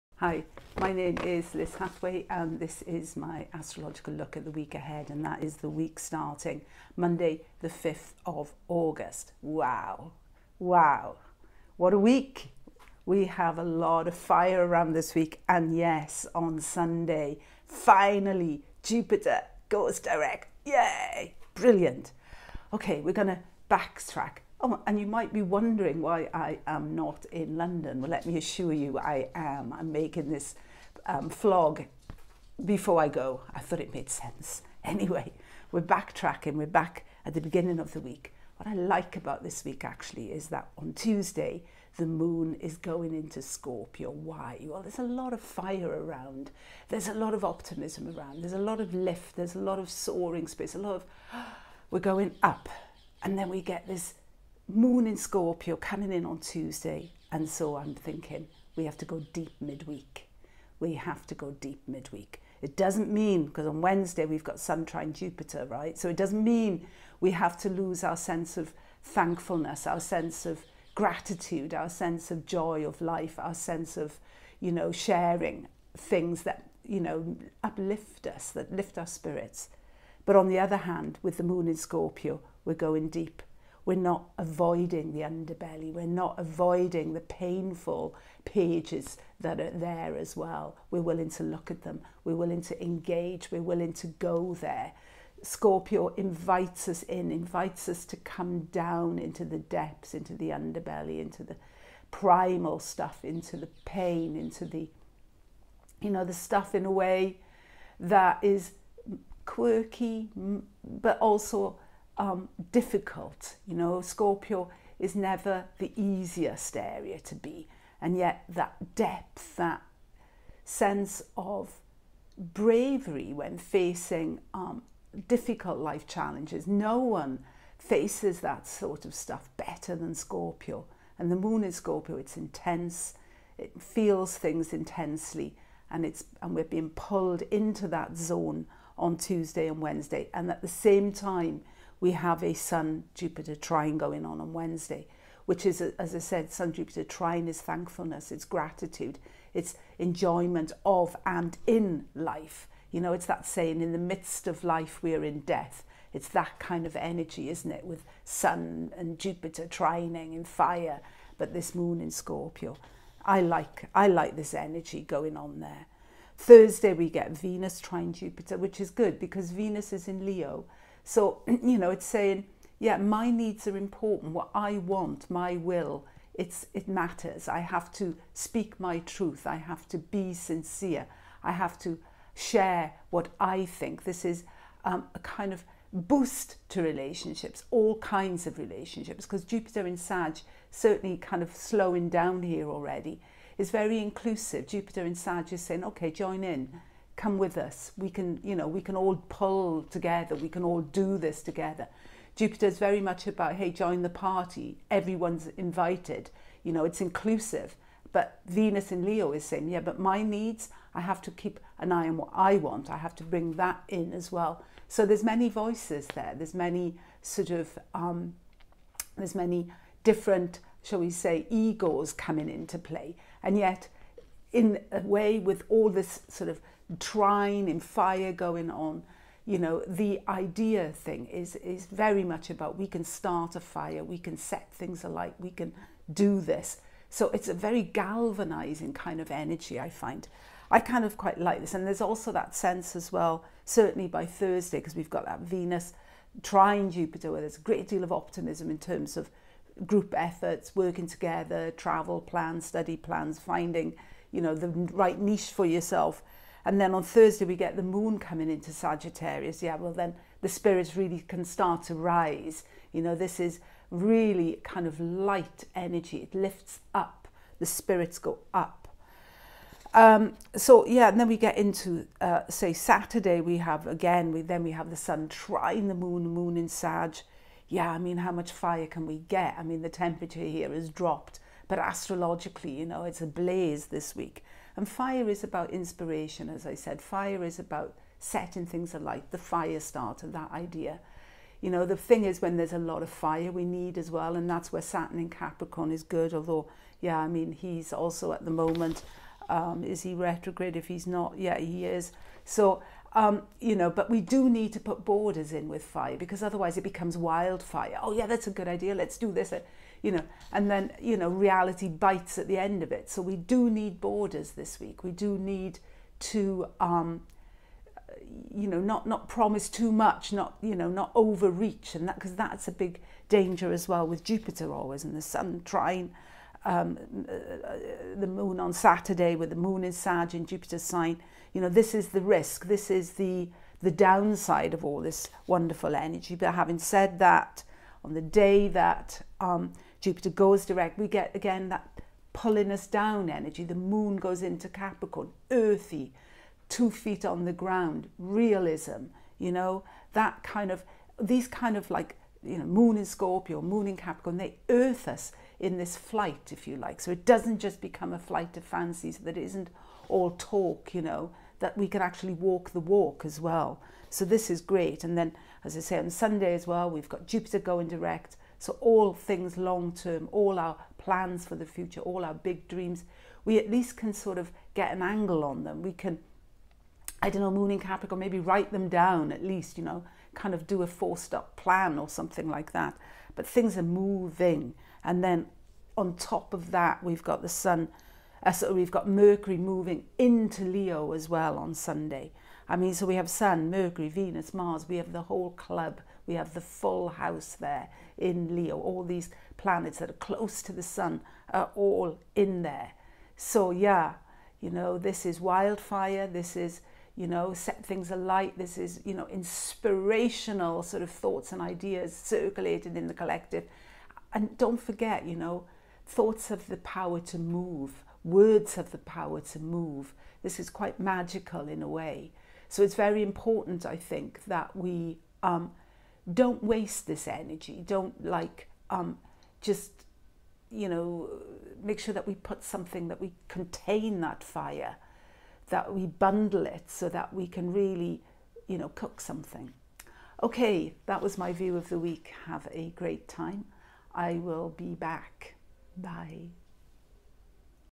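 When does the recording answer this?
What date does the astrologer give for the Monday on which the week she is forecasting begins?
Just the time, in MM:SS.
00:07.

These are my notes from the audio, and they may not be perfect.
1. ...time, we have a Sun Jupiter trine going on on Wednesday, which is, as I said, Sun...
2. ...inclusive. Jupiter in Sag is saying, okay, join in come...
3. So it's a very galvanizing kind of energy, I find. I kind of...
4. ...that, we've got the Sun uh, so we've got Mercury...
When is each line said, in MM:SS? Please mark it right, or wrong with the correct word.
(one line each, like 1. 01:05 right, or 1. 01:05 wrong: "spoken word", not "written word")
1. 02:21 right
2. 03:13 right
3. 03:57 right
4. 06:26 right.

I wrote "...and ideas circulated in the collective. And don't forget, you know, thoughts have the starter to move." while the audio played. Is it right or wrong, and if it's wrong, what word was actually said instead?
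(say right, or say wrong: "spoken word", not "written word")
wrong: "power", not "starter".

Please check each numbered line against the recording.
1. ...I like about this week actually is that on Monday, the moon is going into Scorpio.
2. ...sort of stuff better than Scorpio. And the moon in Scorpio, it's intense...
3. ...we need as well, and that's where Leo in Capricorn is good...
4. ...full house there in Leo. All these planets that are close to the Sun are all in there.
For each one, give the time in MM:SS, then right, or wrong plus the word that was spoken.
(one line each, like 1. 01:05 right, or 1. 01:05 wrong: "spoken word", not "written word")
1. 00:38 wrong: "Tuesday", not "Monday"
2. 02:08 right
3. 04:53 wrong: "Saturn", not "Leo"
4. 06:36 right.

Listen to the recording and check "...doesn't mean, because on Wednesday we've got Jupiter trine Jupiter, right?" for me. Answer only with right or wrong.
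wrong.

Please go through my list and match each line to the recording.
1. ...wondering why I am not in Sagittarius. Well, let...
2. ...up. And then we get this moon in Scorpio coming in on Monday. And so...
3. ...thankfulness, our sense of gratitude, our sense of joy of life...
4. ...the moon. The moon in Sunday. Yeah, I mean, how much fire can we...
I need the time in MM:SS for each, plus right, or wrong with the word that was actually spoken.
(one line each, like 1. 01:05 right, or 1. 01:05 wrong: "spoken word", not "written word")
1. 00:25 wrong: "London", not "Sagittarius"
2. 00:52 wrong: "Tuesday", not "Monday"
3. 01:09 right
4. 04:35 wrong: "Sag", not "Sunday".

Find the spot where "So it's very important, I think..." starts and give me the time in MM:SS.
07:02.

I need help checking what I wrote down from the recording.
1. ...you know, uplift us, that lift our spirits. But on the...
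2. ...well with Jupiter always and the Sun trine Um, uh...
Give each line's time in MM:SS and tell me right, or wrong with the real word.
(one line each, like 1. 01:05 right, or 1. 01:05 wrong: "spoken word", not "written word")
1. 01:16 right
2. 05:23 right.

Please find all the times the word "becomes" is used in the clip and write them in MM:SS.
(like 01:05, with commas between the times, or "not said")
05:06, 05:57.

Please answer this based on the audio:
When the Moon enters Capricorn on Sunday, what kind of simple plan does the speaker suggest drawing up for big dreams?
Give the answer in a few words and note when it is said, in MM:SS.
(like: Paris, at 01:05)
four step plan, at 06:20.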